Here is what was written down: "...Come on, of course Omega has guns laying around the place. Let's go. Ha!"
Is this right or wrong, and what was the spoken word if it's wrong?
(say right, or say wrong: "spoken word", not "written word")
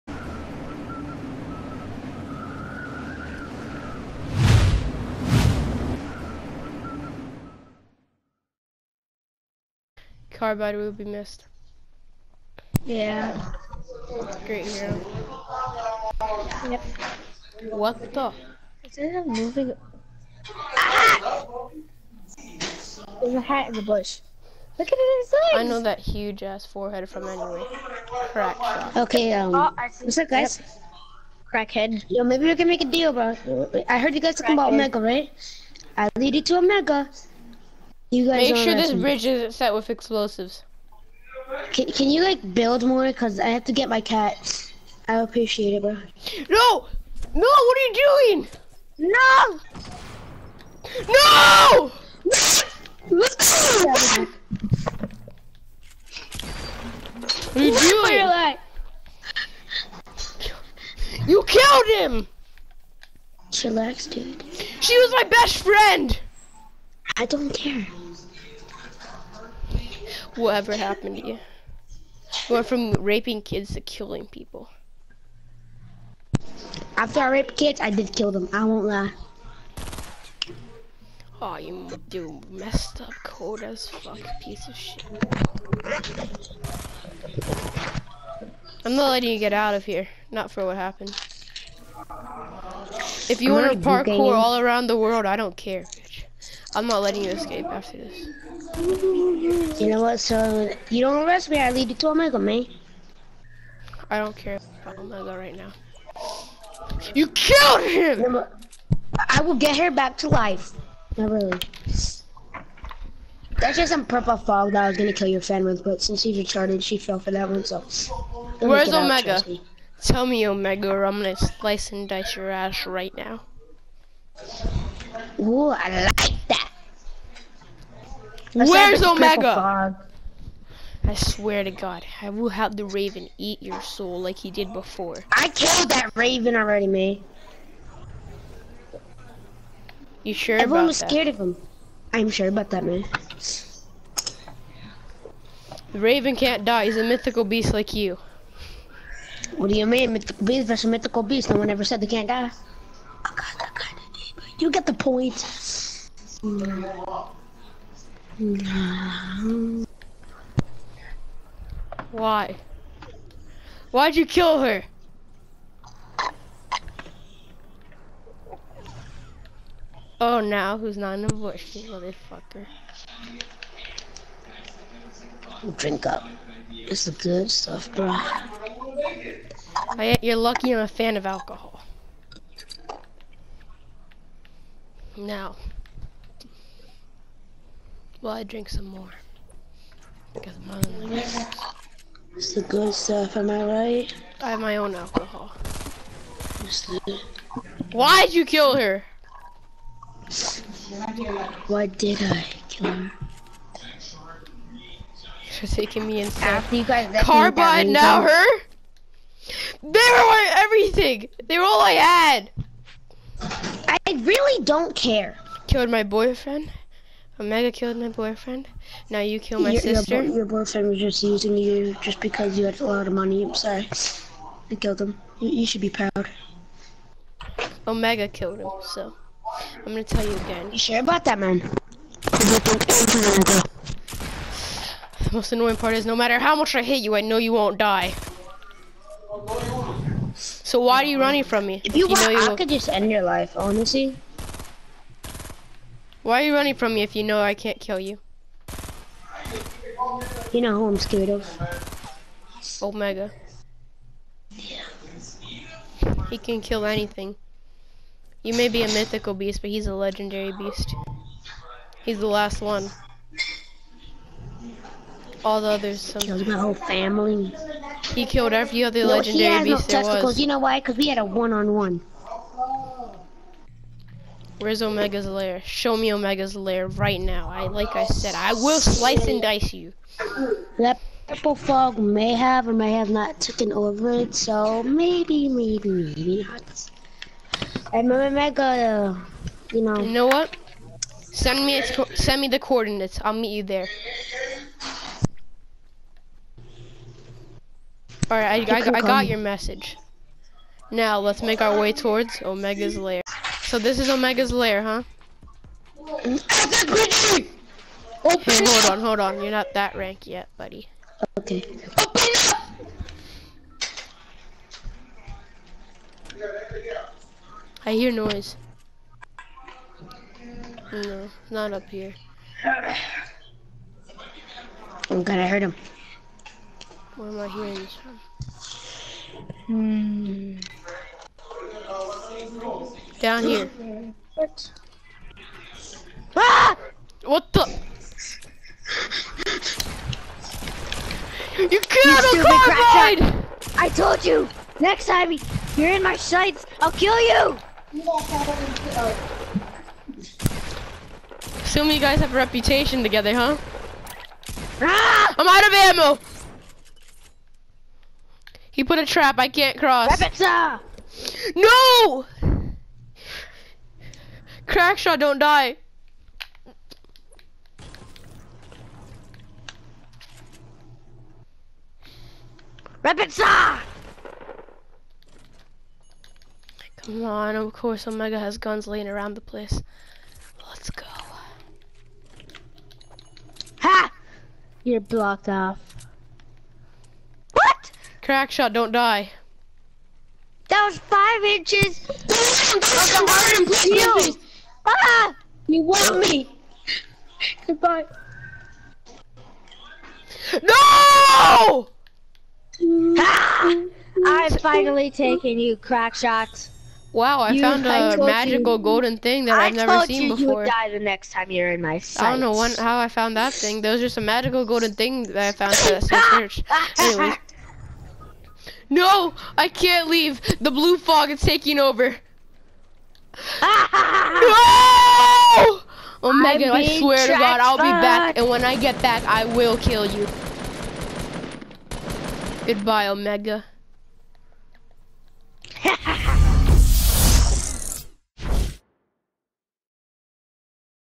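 right.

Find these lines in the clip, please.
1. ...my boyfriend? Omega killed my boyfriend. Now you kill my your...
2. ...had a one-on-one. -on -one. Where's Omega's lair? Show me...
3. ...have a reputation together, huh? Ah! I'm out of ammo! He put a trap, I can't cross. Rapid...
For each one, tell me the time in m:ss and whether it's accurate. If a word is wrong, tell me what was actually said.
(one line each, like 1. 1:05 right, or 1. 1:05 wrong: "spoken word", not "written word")
1. 3:35 right
2. 4:31 right
3. 5:52 right.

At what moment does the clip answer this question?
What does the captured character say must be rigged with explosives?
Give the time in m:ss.
0:38.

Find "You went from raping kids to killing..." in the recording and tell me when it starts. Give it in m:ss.
1:12.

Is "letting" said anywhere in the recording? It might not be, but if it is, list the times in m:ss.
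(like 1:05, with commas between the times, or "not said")
1:29, 1:37.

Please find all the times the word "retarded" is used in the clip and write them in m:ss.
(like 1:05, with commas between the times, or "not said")
1:56.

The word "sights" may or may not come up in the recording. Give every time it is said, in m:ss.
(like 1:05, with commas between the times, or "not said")
5:46, 6:51.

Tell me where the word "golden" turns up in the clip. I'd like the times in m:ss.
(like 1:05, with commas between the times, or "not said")
6:48, 6:54.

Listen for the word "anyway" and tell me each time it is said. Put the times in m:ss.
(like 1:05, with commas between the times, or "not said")
0:27, 6:56.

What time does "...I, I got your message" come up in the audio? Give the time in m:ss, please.
4:58.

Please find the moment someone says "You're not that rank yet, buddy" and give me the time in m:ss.
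5:09.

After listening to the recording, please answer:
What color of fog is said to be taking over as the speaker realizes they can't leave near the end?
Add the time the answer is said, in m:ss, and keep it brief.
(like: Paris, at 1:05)
blue, at 7:00.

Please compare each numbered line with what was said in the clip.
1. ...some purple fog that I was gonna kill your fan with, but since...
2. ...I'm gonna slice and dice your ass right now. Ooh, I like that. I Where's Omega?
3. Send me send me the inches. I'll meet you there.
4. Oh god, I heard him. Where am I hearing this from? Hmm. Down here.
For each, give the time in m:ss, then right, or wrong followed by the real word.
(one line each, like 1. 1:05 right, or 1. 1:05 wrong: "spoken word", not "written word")
1. 1:53 right
2. 2:01 right
3. 4:51 wrong: "coordinates", not "inches"
4. 5:25 right.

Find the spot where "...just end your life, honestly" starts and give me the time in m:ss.
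4:02.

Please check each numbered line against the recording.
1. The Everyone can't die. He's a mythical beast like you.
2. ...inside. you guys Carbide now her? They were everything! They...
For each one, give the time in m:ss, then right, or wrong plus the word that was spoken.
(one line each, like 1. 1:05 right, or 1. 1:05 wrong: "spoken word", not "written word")
1. 2:25 wrong: "Raven", not "Everyone"
2. 3:26 right.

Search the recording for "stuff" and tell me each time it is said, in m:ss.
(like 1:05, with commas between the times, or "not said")
2:57, 3:12.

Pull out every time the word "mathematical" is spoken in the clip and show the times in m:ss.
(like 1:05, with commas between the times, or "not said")
not said.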